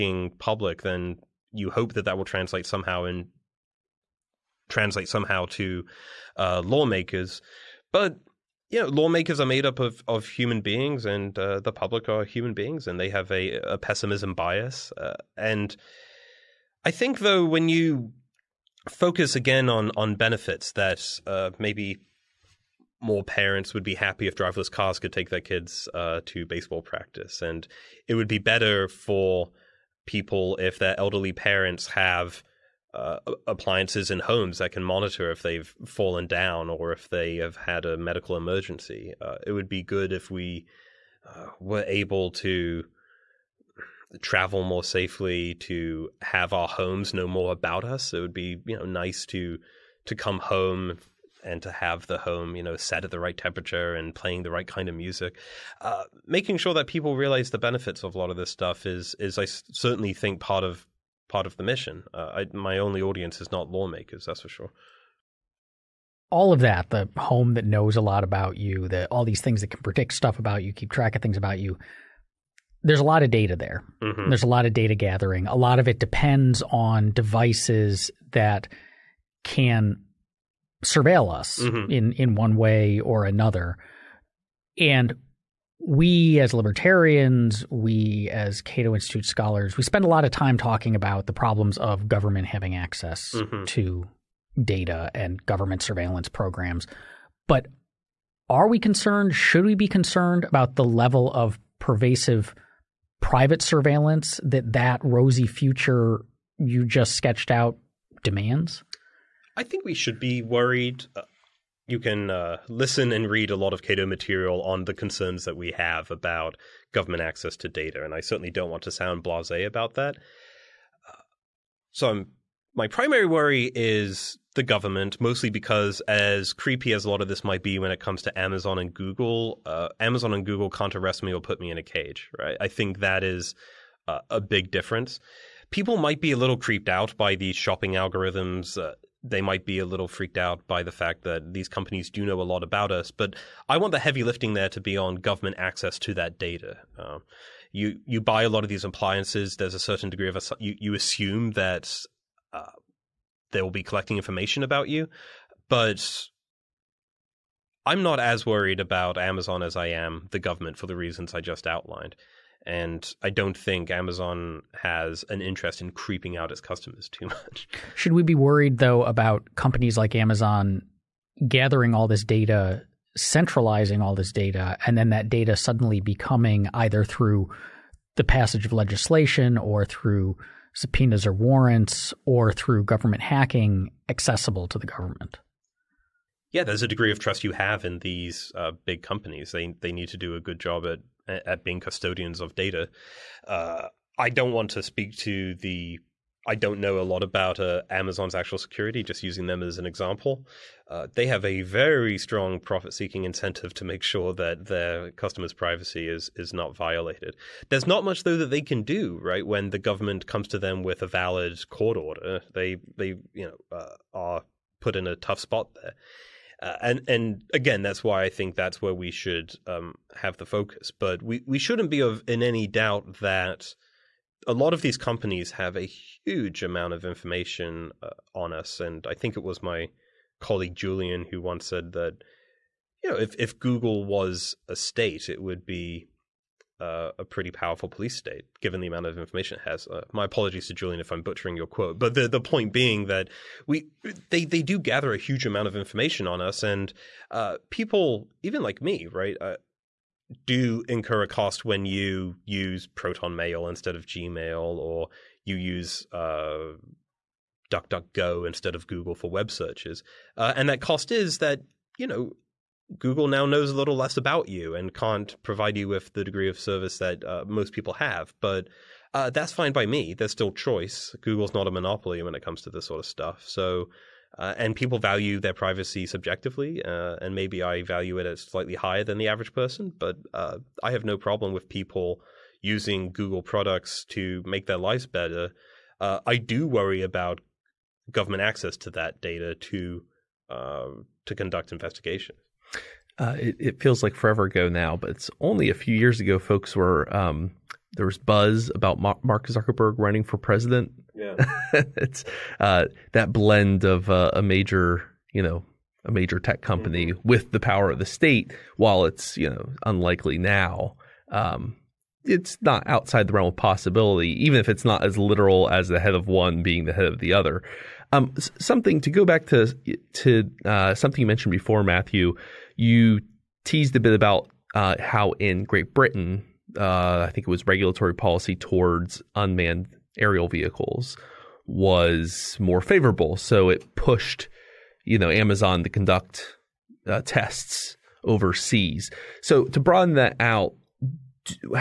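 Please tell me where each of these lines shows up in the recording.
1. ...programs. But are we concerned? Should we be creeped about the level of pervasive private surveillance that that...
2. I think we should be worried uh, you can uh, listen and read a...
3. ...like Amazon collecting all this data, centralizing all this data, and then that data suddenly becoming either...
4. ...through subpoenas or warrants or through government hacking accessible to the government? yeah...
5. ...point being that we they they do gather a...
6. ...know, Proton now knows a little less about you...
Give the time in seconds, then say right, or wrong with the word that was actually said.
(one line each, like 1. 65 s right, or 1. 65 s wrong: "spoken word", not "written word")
1. 96 s wrong: "concerned", not "creeped"
2. 109 s right
3. 169 s wrong: "gathering", not "collecting"
4. 179 s right
5. 242 s right
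6. 262 s wrong: "Google", not "Proton".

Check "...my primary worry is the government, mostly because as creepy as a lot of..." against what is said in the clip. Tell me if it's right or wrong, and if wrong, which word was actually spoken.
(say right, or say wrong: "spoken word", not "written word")
right.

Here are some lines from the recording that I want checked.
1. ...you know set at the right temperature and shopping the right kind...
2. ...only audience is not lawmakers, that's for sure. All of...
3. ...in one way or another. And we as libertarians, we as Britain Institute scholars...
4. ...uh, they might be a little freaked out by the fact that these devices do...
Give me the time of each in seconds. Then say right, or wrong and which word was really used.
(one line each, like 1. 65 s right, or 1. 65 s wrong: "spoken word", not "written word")
1. 52 s wrong: "playing", not "shopping"
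2. 62 s right
3. 82 s wrong: "Cato", not "Britain"
4. 138 s wrong: "companies", not "devices".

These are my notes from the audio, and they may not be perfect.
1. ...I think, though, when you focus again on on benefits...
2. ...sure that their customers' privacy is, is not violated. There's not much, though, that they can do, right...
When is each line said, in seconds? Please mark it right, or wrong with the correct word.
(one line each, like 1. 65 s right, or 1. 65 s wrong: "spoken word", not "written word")
1. 16 s right
2. 204 s right.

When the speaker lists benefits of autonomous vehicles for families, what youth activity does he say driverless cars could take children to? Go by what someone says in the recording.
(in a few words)
baseball practice.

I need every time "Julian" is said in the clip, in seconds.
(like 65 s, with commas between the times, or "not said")
230 s, 240 s.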